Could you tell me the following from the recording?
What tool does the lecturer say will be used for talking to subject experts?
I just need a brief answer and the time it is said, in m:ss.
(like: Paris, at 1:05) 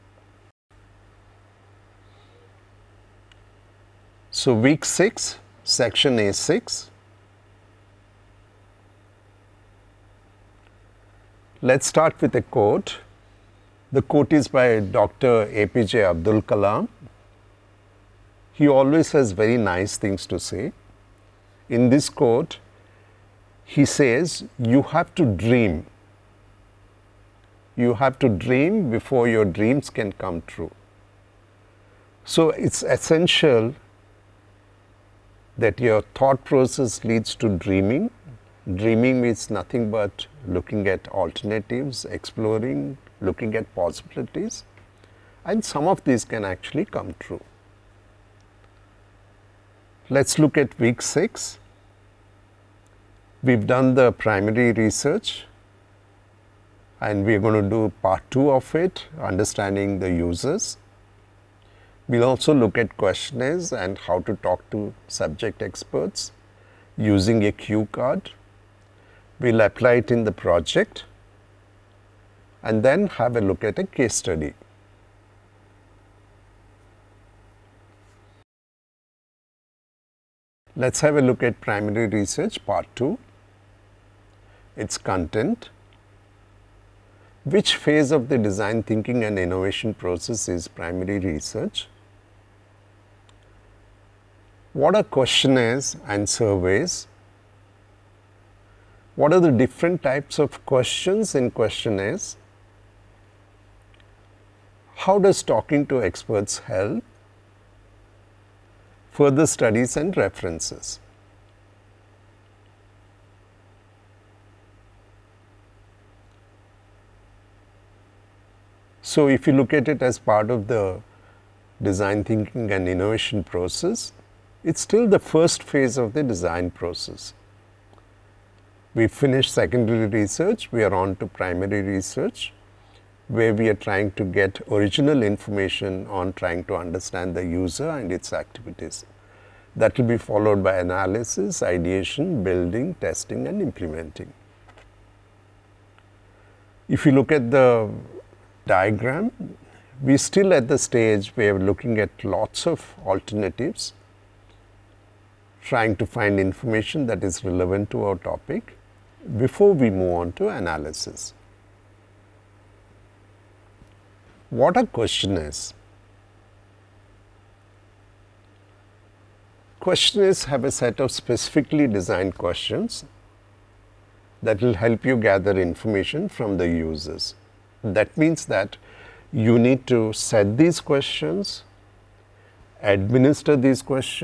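a cue card, at 1:07.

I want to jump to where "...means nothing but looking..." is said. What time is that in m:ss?
0:39.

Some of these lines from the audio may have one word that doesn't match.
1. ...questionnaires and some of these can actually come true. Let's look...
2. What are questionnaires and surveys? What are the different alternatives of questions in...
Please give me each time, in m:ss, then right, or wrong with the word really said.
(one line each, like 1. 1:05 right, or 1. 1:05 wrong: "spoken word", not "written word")
1. 0:43 wrong: "possibilities", not "questionnaires"
2. 1:34 wrong: "types", not "alternatives".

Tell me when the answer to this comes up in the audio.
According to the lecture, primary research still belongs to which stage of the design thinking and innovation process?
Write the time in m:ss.
2:05.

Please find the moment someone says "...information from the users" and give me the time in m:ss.
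2:55.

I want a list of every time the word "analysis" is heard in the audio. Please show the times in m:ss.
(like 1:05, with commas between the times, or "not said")
2:20, 2:40.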